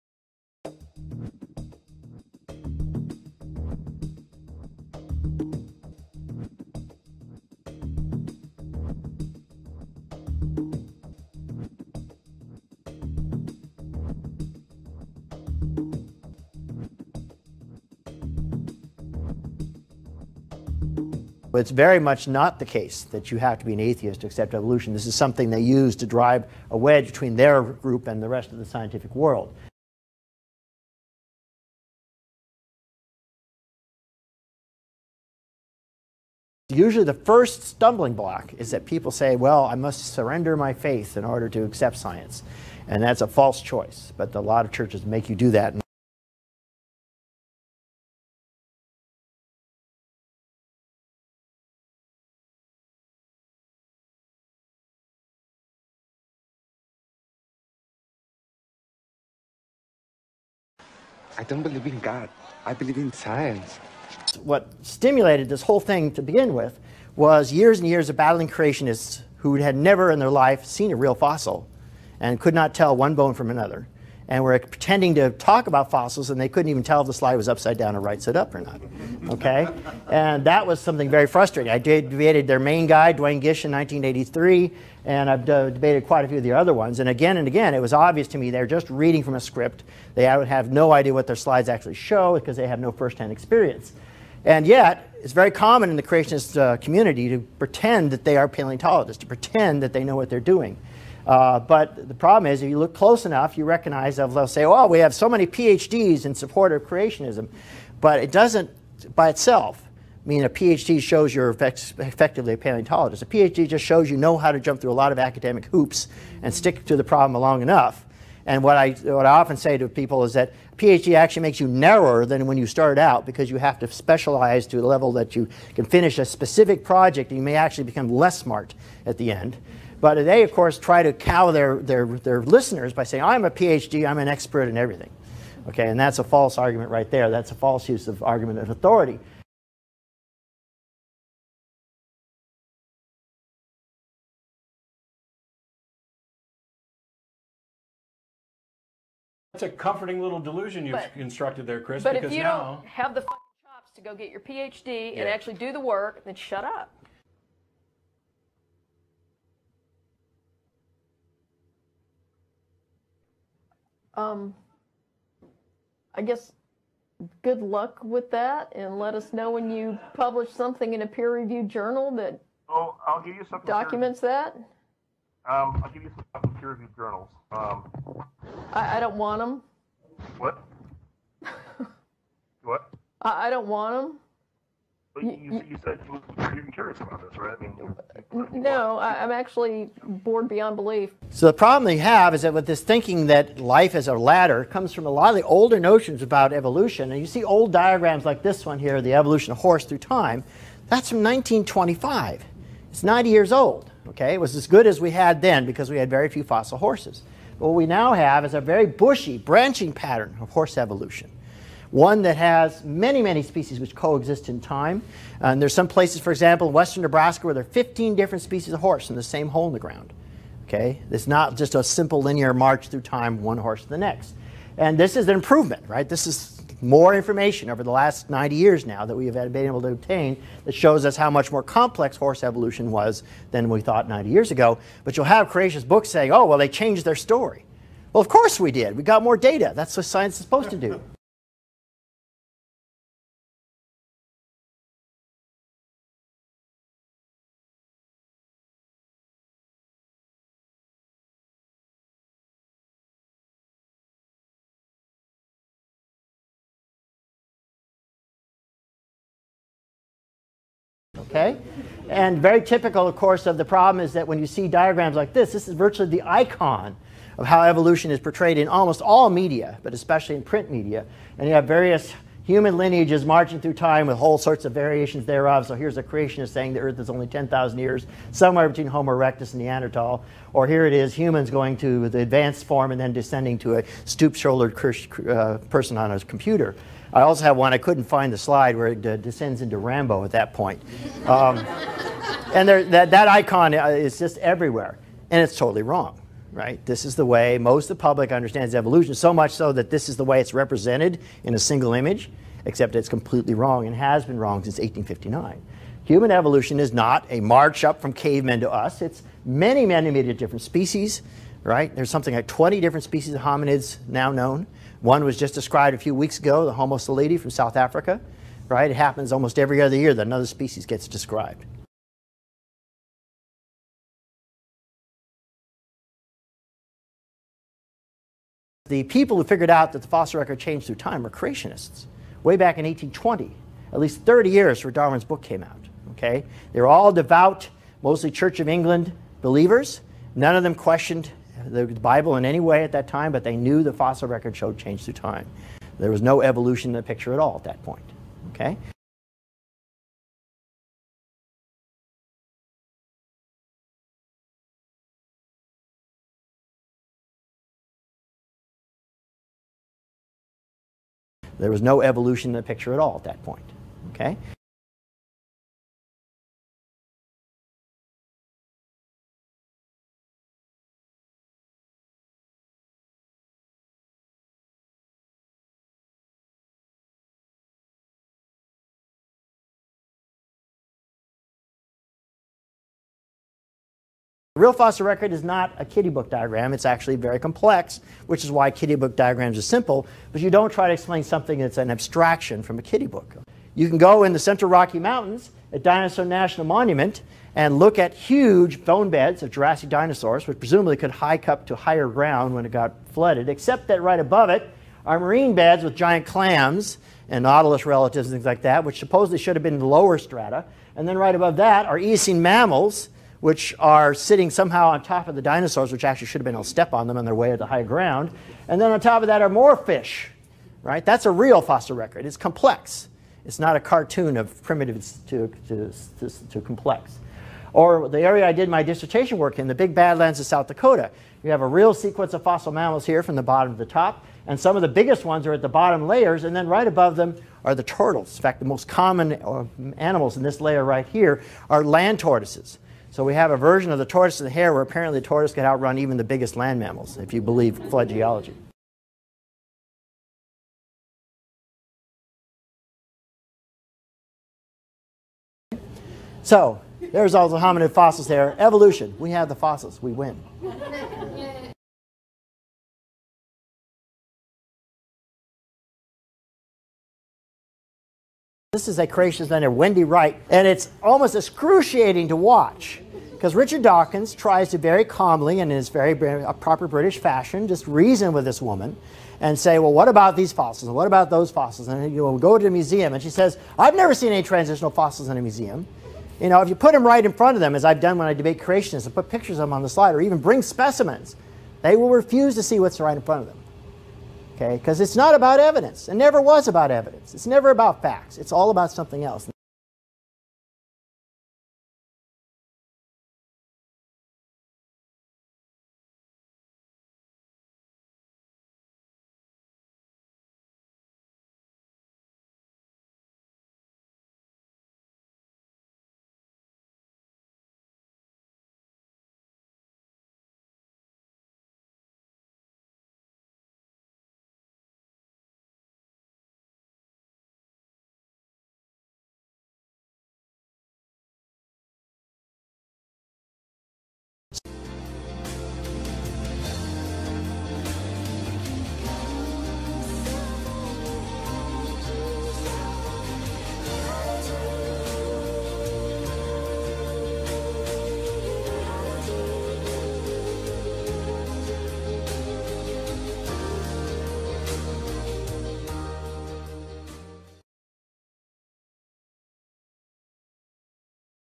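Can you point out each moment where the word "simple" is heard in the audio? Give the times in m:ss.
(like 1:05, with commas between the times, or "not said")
3:41, 6:29.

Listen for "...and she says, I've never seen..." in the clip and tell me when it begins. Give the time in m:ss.
8:03.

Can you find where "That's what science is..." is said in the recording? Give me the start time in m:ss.
3:59.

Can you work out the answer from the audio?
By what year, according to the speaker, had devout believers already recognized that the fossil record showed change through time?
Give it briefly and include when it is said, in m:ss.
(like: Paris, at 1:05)
1820, at 5:32.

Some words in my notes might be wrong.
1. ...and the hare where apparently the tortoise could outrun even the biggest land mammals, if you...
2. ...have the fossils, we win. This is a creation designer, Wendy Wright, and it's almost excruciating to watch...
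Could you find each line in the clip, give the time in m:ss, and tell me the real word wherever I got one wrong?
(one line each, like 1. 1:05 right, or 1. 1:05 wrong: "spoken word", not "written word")
1. 7:24 right
2. 7:39 right.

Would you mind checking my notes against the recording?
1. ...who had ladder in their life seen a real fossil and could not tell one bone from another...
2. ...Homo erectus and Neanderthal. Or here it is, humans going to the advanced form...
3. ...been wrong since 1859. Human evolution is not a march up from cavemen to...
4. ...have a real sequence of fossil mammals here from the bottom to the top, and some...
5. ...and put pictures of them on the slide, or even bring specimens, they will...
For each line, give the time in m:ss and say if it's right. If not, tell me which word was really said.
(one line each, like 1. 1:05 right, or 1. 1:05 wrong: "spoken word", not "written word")
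1. 1:09 wrong: "never", not "ladder"
2. 4:38 right
3. 5:04 right
4. 7:11 right
5. 8:09 right.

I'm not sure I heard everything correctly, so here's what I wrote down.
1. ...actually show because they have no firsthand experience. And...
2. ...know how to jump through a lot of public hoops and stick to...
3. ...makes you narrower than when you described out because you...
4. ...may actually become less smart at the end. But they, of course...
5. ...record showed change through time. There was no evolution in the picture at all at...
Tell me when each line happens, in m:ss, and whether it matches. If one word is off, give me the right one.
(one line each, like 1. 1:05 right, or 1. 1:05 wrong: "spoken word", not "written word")
1. 1:31 right
2. 1:54 wrong: "academic", not "public"
3. 2:01 wrong: "started", not "described"
4. 2:07 right
5. 5:44 right.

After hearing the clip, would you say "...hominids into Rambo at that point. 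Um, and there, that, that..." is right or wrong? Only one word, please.
wrong.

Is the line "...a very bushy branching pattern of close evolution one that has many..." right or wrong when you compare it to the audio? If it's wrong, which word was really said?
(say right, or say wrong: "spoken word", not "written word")
wrong: "horse", not "close".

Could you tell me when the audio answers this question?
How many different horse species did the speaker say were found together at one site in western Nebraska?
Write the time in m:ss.
3:37.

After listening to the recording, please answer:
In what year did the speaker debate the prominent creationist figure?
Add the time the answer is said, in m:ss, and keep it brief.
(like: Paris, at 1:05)
1983, at 1:23.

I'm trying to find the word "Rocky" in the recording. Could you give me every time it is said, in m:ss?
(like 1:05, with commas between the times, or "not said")
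6:34.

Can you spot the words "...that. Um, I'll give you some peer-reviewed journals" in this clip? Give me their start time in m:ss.
2:54.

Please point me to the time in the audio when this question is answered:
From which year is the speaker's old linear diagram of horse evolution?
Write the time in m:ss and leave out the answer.
3:21.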